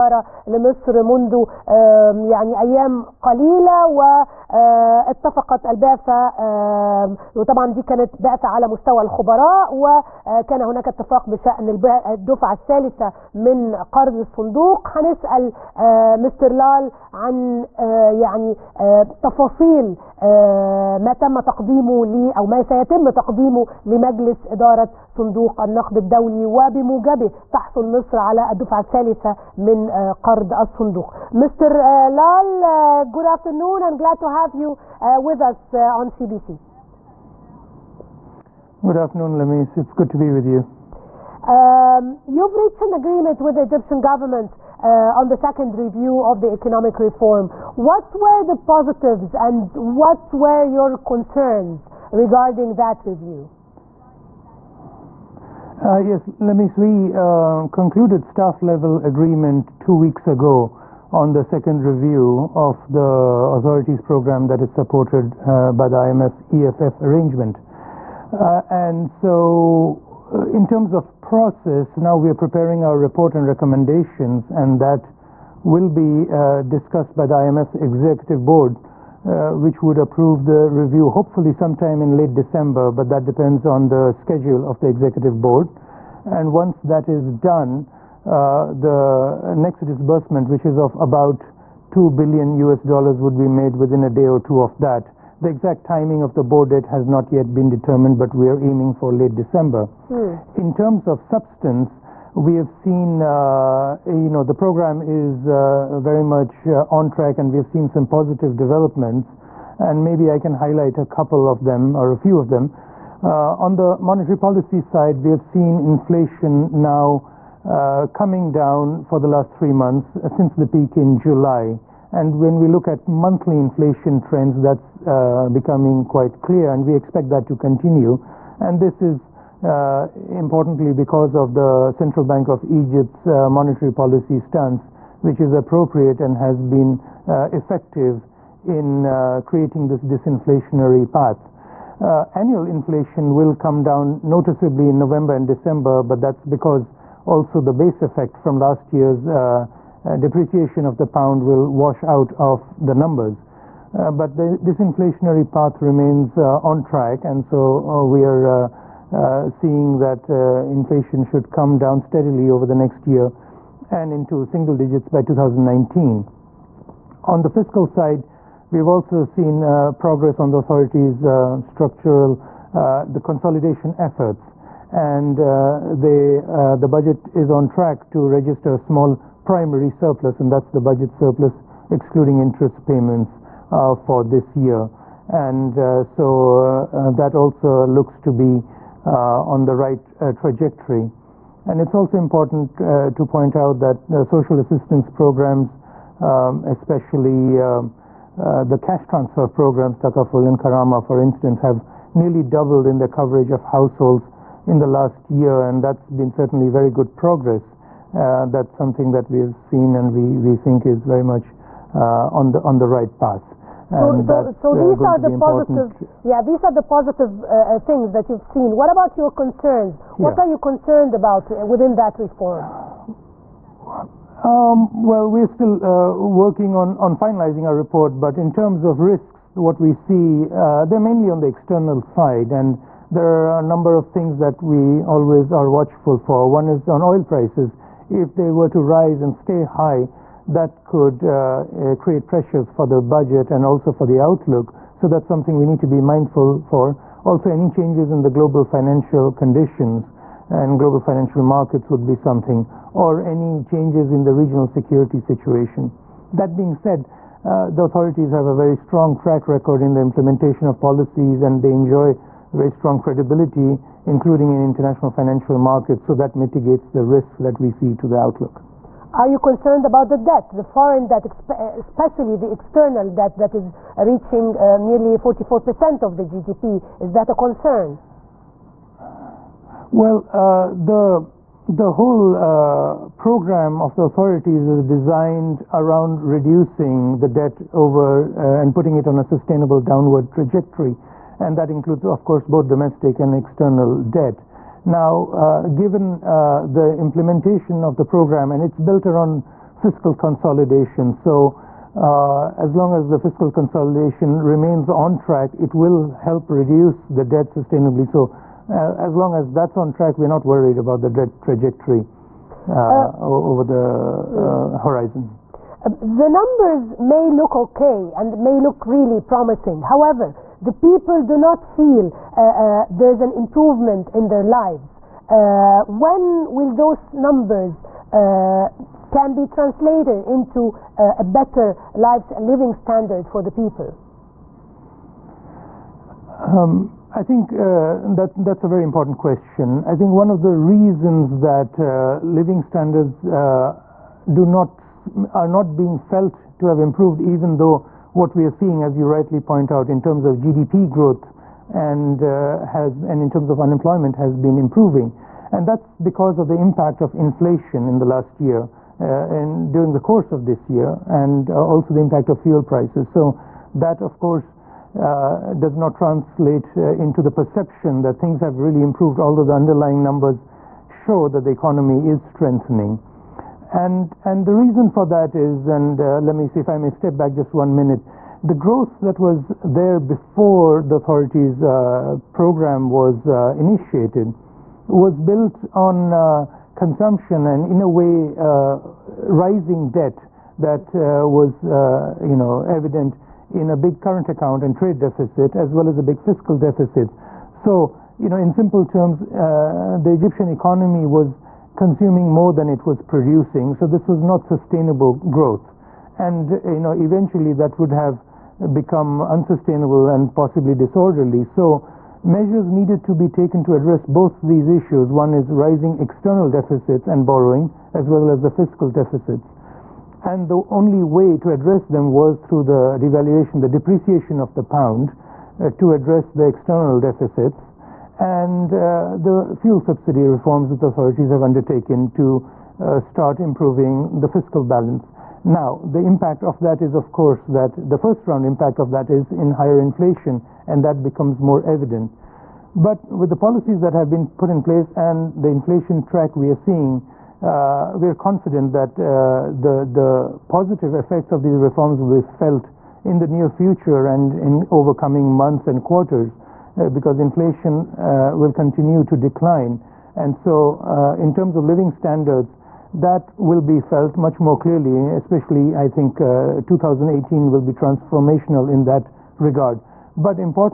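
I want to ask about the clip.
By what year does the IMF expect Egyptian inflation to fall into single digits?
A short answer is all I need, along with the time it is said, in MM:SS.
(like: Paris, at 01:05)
2019, at 02:45.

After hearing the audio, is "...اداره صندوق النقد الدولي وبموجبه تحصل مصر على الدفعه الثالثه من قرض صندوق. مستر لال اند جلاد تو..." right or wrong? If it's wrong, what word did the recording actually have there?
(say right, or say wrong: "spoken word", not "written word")
wrong: "الصندوق", not "صندوق".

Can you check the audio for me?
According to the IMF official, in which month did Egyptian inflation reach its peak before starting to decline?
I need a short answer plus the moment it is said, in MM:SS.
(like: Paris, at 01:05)
July, at 02:01.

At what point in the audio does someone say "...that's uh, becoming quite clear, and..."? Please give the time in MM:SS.
02:04.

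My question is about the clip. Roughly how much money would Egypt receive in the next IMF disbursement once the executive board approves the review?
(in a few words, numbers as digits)
2 billion US dollars.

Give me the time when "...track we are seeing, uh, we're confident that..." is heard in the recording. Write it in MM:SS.
07:26.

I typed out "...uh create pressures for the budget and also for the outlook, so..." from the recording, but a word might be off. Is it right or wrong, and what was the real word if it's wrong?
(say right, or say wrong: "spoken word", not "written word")
right.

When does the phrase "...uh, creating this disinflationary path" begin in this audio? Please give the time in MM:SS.
02:19.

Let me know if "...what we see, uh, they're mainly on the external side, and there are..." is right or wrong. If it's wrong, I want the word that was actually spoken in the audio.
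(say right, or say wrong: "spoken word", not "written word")
right.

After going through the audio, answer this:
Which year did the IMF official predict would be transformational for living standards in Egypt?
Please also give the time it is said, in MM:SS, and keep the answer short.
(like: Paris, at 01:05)
2018, at 07:46.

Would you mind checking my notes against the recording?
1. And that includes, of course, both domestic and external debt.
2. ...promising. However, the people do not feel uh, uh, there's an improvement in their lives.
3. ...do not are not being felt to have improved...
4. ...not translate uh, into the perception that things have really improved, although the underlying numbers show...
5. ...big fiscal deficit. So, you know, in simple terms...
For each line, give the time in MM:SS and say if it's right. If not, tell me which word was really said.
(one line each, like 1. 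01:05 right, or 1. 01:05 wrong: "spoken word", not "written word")
1. 04:51 right
2. 05:19 right
3. 05:44 right
4. 06:05 right
5. 06:36 right.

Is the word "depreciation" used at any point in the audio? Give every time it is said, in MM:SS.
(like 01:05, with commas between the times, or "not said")
02:30, 07:03.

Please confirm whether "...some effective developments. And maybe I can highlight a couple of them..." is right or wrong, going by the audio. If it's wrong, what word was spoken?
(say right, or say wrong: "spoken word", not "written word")
wrong: "positive", not "effective".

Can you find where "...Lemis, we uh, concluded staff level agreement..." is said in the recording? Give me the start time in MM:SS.
00:56.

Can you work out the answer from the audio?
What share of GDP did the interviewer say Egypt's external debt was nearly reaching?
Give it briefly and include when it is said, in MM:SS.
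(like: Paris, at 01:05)
44%, at 04:35.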